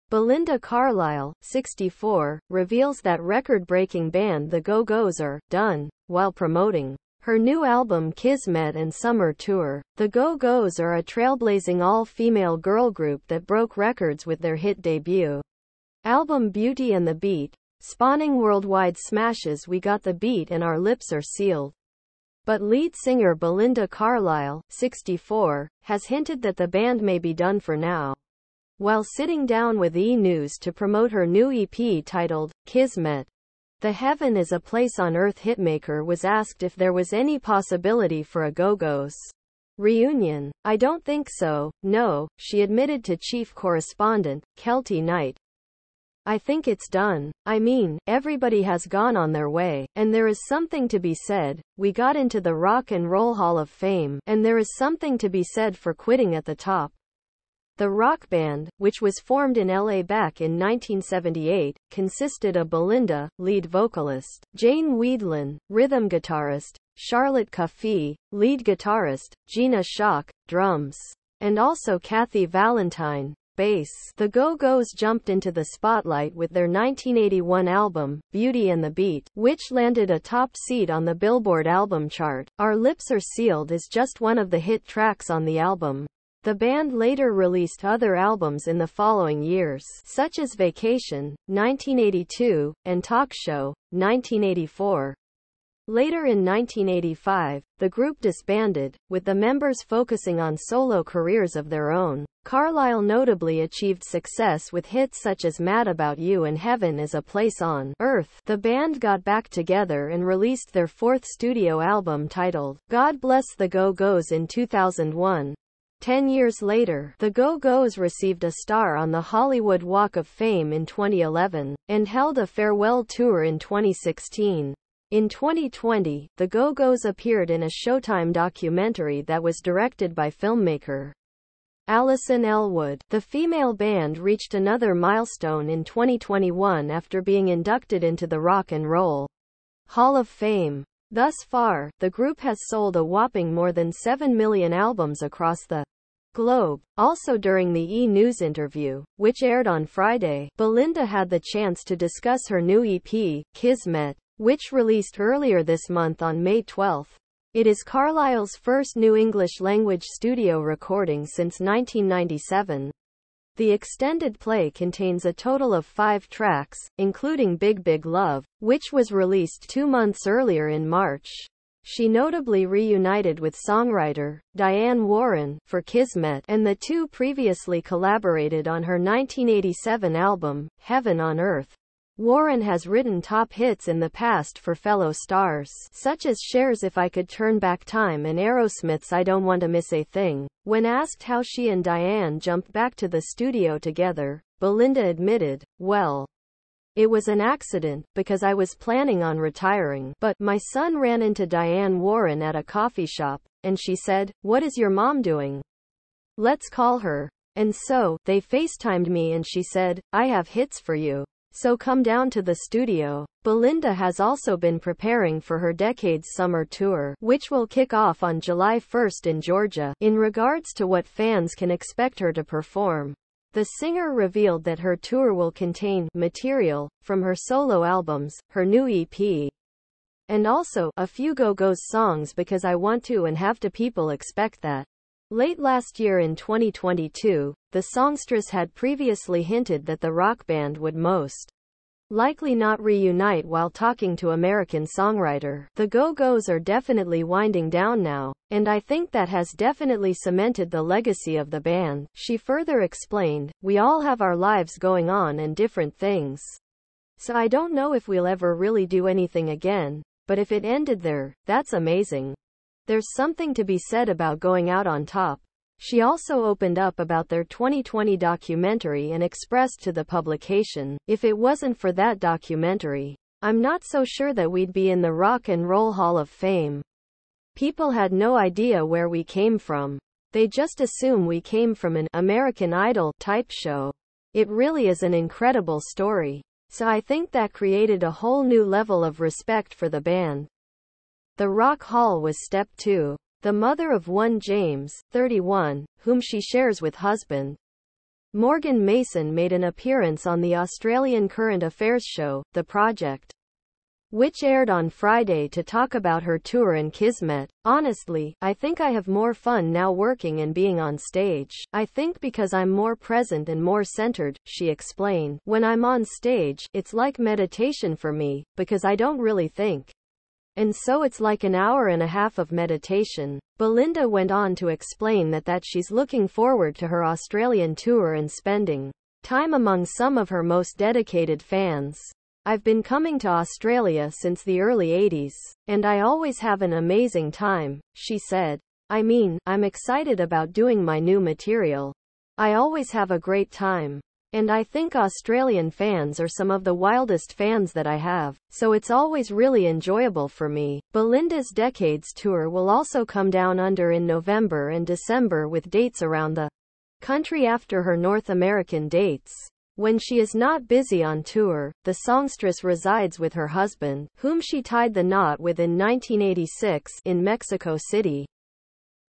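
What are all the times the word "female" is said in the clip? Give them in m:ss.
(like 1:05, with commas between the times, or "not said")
0:11, 2:13.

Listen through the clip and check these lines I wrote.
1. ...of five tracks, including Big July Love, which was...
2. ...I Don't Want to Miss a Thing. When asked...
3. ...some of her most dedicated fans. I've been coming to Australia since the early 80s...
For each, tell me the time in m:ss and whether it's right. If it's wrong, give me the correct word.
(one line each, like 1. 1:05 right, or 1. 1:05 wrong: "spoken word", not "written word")
1. 2:45 wrong: "Big", not "July"
2. 3:09 right
3. 5:29 right.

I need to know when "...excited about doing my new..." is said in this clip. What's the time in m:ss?
5:39.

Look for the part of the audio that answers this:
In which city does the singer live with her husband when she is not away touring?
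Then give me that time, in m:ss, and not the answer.
6:07.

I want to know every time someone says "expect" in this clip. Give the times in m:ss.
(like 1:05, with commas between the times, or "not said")
3:41, 3:54.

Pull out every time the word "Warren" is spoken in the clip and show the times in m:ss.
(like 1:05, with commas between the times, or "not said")
2:55, 3:02, 3:22.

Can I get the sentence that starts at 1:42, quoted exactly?
Carlisle notably achieved success with hits such as Mad About You and Heaven is a Place on Earth.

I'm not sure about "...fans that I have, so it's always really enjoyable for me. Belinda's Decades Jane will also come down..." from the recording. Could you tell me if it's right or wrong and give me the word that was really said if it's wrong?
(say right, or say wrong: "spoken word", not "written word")
wrong: "Tour", not "Jane".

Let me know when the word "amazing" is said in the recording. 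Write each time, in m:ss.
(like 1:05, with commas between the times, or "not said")
4:21, 5:36.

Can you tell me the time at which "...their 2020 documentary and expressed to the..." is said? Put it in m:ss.
4:27.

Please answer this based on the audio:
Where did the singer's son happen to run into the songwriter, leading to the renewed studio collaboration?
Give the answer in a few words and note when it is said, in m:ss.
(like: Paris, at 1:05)
A coffee shop, at 3:22.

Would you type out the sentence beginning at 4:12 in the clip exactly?
She further explained, we all have our lives going on and different things.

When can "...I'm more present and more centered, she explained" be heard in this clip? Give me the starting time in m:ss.
5:12.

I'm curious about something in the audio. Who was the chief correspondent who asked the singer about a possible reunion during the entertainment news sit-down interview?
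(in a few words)
Kelty Knight.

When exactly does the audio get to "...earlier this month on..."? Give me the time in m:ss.
2:35.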